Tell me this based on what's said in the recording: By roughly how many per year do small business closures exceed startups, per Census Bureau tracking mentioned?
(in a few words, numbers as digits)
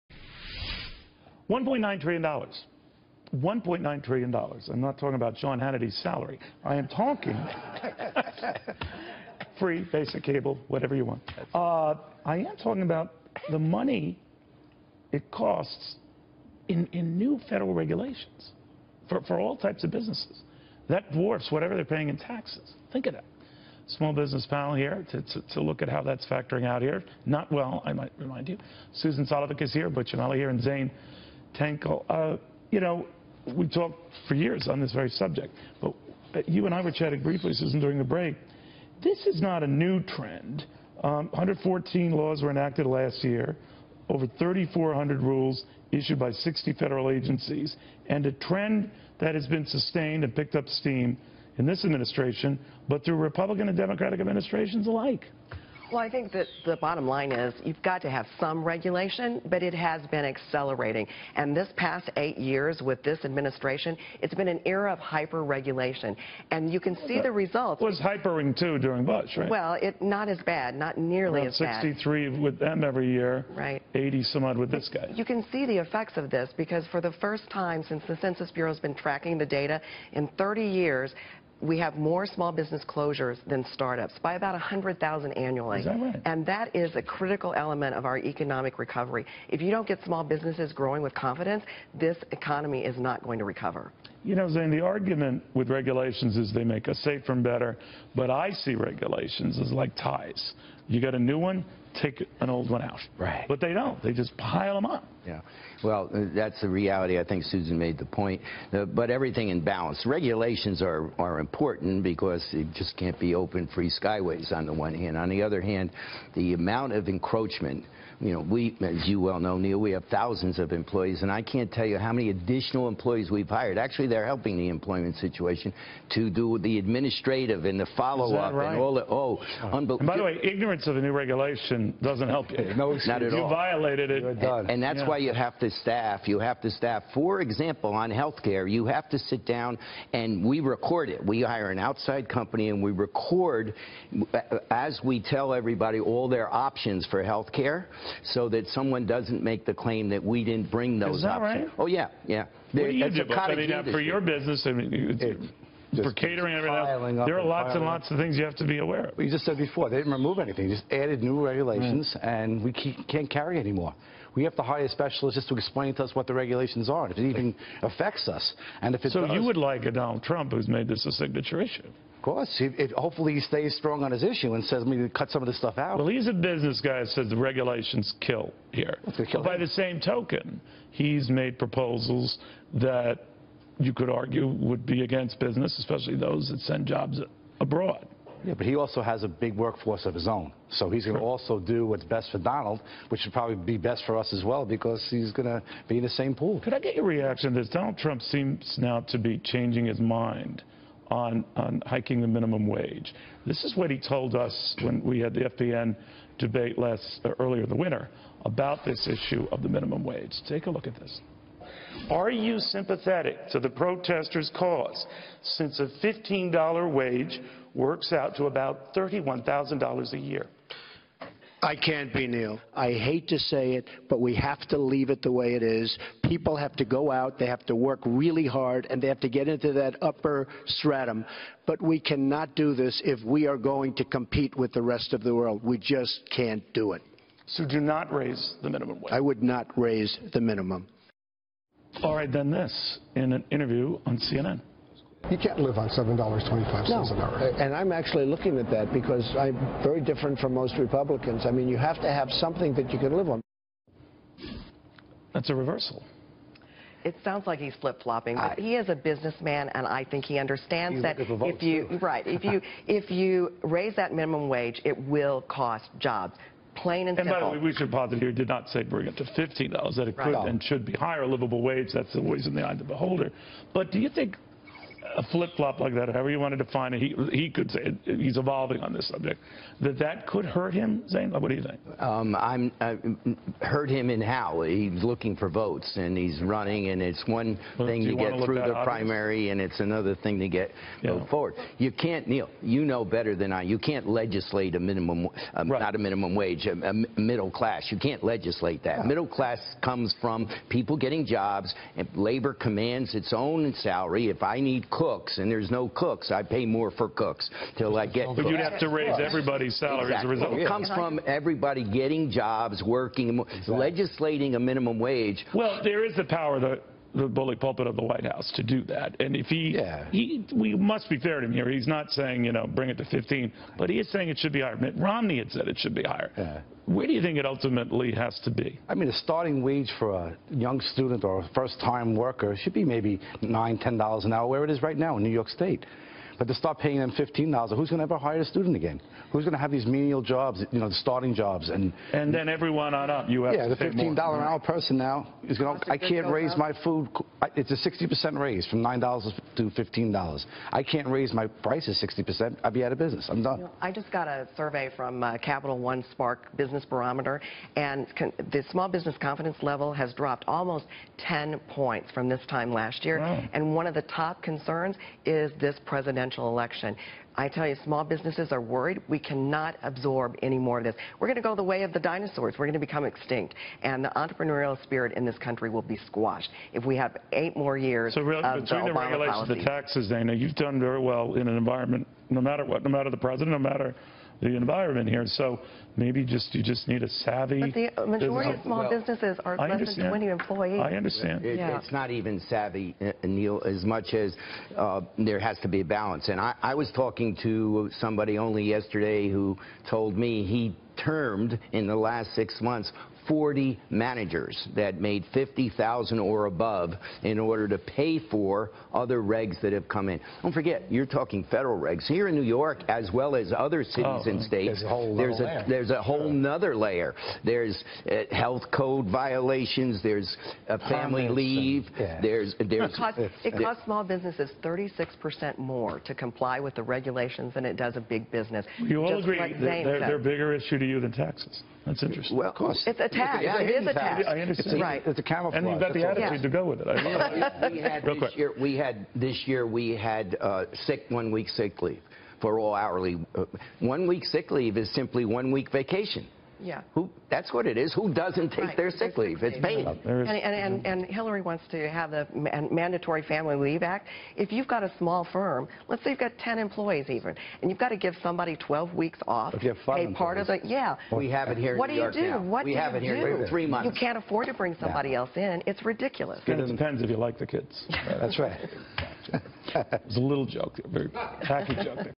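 100,000.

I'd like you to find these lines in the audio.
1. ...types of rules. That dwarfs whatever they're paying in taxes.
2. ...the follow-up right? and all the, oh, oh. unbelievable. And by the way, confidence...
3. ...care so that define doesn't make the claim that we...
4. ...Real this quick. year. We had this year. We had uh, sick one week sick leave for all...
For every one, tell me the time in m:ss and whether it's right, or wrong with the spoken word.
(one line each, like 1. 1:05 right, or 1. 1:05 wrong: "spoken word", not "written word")
1. 0:19 wrong: "businesses", not "rules"
2. 2:07 wrong: "ignorance", not "confidence"
3. 2:27 wrong: "someone", not "define"
4. 7:18 right.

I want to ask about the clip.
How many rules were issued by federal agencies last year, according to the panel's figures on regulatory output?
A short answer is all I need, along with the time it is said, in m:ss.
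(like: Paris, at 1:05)
3,400, at 0:44.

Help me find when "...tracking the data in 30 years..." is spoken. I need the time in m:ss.
1:18.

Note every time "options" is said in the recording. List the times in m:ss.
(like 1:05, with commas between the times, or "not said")
2:26, 2:31.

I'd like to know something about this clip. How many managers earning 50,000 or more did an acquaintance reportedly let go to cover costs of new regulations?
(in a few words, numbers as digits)
40.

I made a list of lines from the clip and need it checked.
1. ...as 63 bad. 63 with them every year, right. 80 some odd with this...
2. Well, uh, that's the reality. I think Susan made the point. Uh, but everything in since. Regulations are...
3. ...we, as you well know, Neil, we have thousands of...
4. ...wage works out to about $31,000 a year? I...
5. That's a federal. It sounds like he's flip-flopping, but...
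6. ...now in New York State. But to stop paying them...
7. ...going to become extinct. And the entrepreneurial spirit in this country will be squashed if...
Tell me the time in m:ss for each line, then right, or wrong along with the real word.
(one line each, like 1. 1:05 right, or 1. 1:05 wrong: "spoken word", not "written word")
1. 1:11 right
2. 1:45 wrong: "balance", not "since"
3. 1:58 right
4. 3:36 right
5. 4:15 wrong: "reversal", not "federal"
6. 5:34 right
7. 6:12 right.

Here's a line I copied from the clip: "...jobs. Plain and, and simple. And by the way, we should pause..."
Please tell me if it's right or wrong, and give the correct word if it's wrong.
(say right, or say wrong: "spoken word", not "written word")
right.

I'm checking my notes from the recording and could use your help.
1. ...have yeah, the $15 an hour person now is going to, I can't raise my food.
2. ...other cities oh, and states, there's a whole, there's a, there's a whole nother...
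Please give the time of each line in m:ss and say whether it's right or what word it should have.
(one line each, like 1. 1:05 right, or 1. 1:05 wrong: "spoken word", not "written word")
1. 5:43 right
2. 6:53 right.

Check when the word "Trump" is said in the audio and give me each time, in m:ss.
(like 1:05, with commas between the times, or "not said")
2:50, 3:17.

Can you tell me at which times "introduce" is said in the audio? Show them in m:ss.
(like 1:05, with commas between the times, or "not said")
not said.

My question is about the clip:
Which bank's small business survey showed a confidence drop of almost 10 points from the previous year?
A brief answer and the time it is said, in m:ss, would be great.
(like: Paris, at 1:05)
Capital One, at 5:55.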